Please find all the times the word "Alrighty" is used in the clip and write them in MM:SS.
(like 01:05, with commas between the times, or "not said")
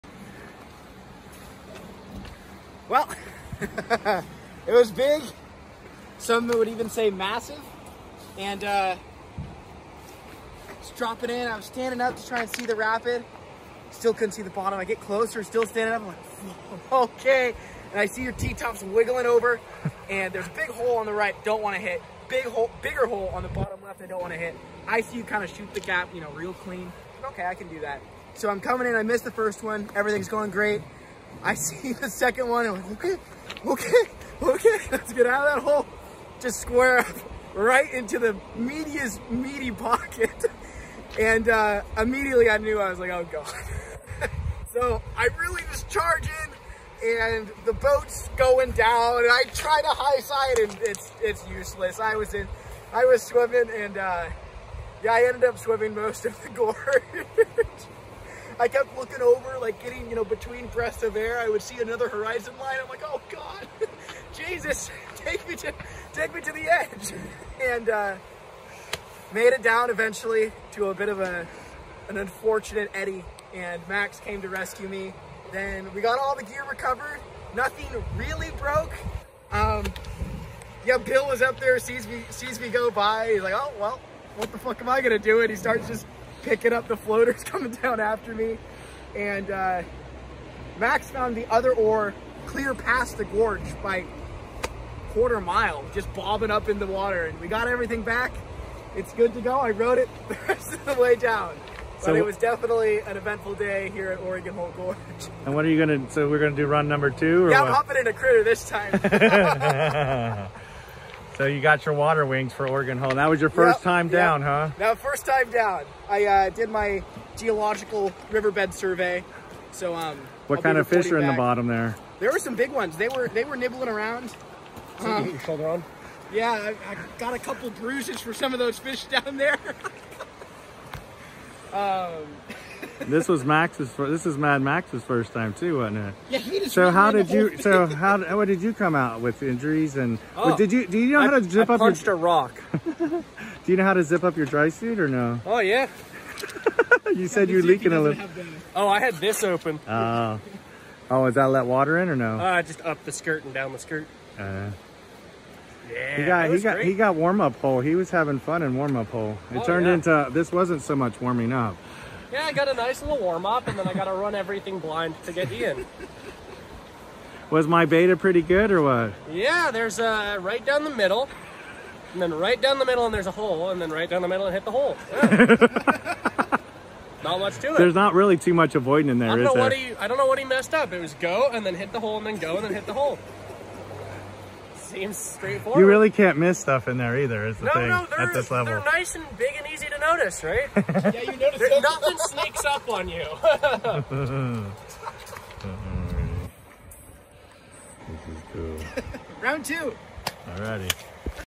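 03:20.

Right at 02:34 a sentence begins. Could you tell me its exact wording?
Uh, yeah, he got he got great.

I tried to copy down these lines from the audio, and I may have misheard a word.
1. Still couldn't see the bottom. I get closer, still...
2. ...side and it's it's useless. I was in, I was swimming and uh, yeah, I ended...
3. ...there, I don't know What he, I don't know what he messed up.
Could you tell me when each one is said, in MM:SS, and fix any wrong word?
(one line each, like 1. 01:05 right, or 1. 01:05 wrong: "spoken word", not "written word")
1. 00:13 right
2. 00:50 right
3. 02:59 right.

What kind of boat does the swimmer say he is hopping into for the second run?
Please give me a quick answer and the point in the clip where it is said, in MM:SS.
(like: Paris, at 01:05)
critter, at 01:48.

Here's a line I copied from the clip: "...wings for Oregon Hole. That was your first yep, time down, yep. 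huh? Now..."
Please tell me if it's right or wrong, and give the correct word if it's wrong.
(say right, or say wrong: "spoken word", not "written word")
right.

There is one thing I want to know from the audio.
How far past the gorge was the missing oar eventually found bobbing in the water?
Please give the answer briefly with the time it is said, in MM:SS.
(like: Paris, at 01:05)
quarter mile, at 01:35.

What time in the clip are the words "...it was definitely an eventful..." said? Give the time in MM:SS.
01:42.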